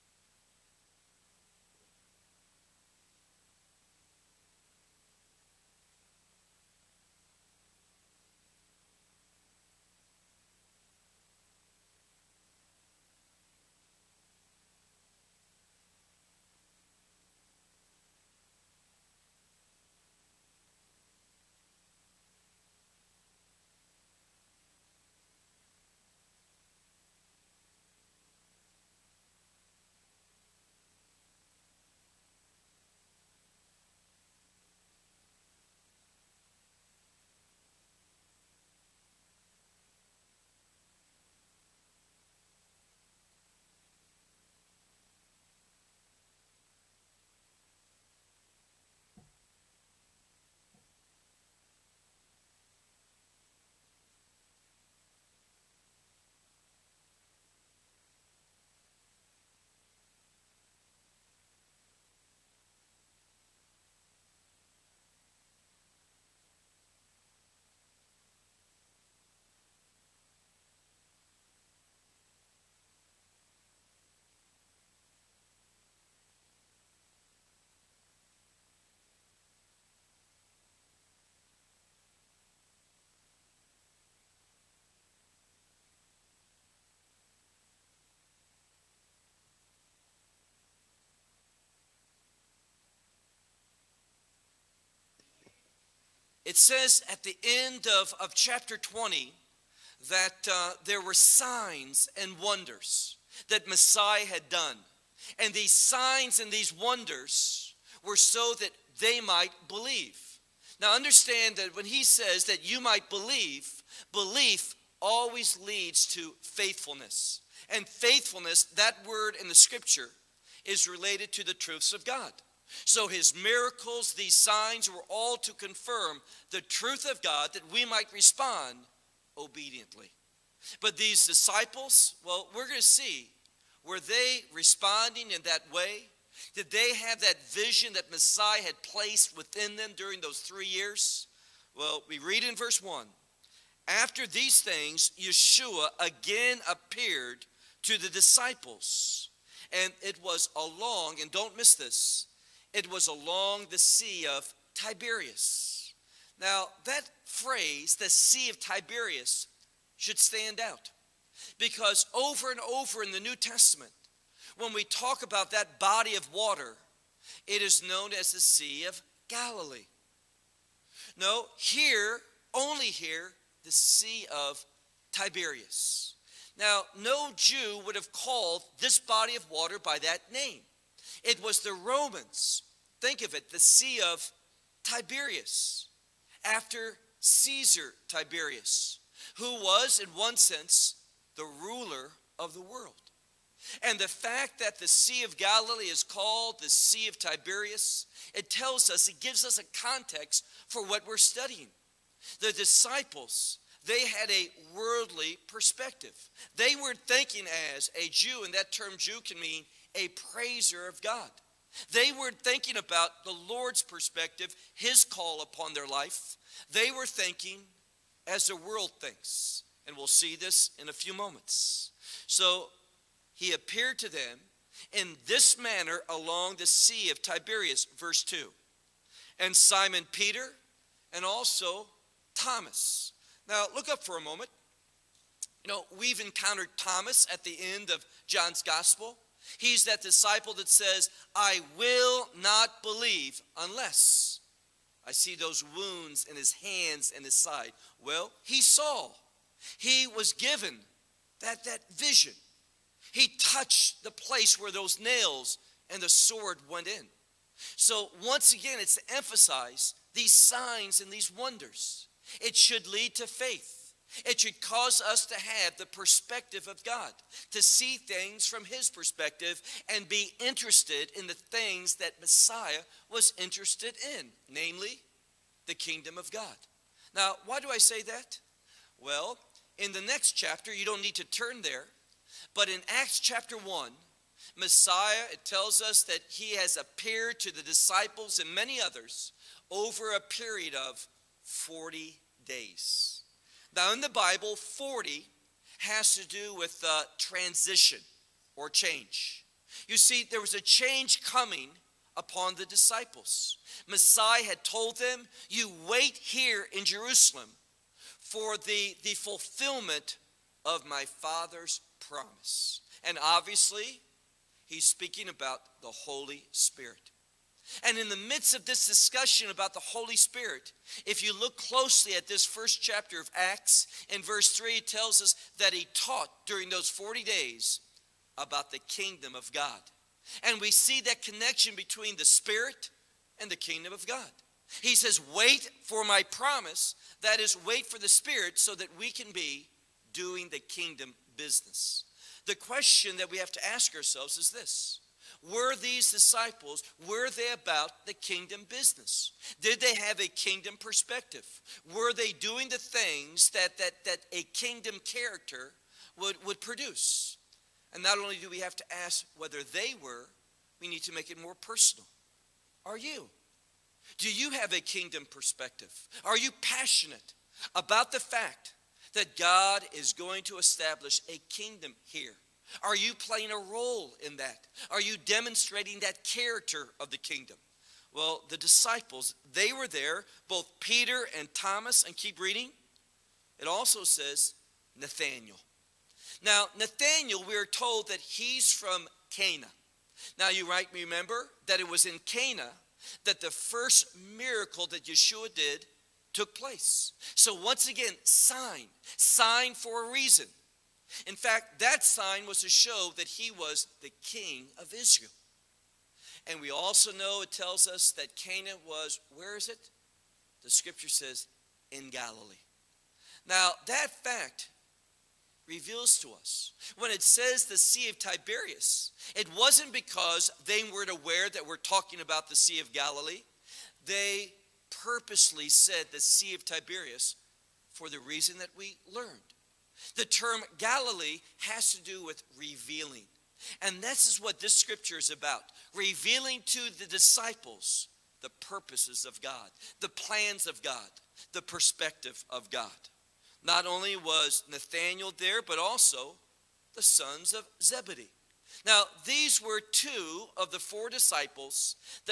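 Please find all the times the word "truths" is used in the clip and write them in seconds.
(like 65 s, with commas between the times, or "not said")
121 s, 126 s.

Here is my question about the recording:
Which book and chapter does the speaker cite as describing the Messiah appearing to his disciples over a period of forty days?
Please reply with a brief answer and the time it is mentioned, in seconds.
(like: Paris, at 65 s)
Acts chapter 1, at 282 s.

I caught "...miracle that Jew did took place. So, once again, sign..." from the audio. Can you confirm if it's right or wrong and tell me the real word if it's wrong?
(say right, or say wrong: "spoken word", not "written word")
wrong: "Yeshua", not "Jew".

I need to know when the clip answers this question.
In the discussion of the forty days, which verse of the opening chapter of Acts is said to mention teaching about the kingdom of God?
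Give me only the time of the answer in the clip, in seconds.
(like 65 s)
324 s.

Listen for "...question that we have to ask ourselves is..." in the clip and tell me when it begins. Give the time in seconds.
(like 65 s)
342 s.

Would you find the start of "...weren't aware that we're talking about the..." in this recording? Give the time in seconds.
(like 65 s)
420 s.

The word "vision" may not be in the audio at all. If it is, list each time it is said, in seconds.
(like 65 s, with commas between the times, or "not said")
137 s, 251 s.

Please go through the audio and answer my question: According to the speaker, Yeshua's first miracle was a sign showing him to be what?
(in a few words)
The king of Israel.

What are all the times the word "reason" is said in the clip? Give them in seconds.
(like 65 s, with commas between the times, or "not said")
400 s, 428 s.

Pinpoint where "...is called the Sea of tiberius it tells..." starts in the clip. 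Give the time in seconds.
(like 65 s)
195 s.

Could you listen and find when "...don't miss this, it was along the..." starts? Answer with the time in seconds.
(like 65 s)
151 s.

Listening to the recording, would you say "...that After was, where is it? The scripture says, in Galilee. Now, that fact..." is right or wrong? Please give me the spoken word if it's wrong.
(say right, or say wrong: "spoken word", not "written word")
wrong: "Cana", not "After".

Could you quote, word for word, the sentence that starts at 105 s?
And these signs and these wonders were so that they might believe.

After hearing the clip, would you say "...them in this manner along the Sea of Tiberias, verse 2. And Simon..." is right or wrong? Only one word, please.
right.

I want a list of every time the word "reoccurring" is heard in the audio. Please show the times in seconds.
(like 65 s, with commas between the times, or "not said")
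not said.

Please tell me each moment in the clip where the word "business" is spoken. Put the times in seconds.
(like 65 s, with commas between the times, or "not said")
341 s, 348 s.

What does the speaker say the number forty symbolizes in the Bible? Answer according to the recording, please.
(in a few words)
Transition or change.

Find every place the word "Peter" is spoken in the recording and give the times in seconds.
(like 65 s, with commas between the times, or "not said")
230 s, 380 s.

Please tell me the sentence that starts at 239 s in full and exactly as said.
He's that disciple that says, I will not believe unless I see those wounds in his hands and his side.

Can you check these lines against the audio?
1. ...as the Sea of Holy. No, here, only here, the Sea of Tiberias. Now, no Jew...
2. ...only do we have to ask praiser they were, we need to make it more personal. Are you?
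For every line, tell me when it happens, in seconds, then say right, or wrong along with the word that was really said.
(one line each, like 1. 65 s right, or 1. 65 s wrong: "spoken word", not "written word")
1. 168 s wrong: "Galilee", not "Holy"
2. 358 s wrong: "whether", not "praiser".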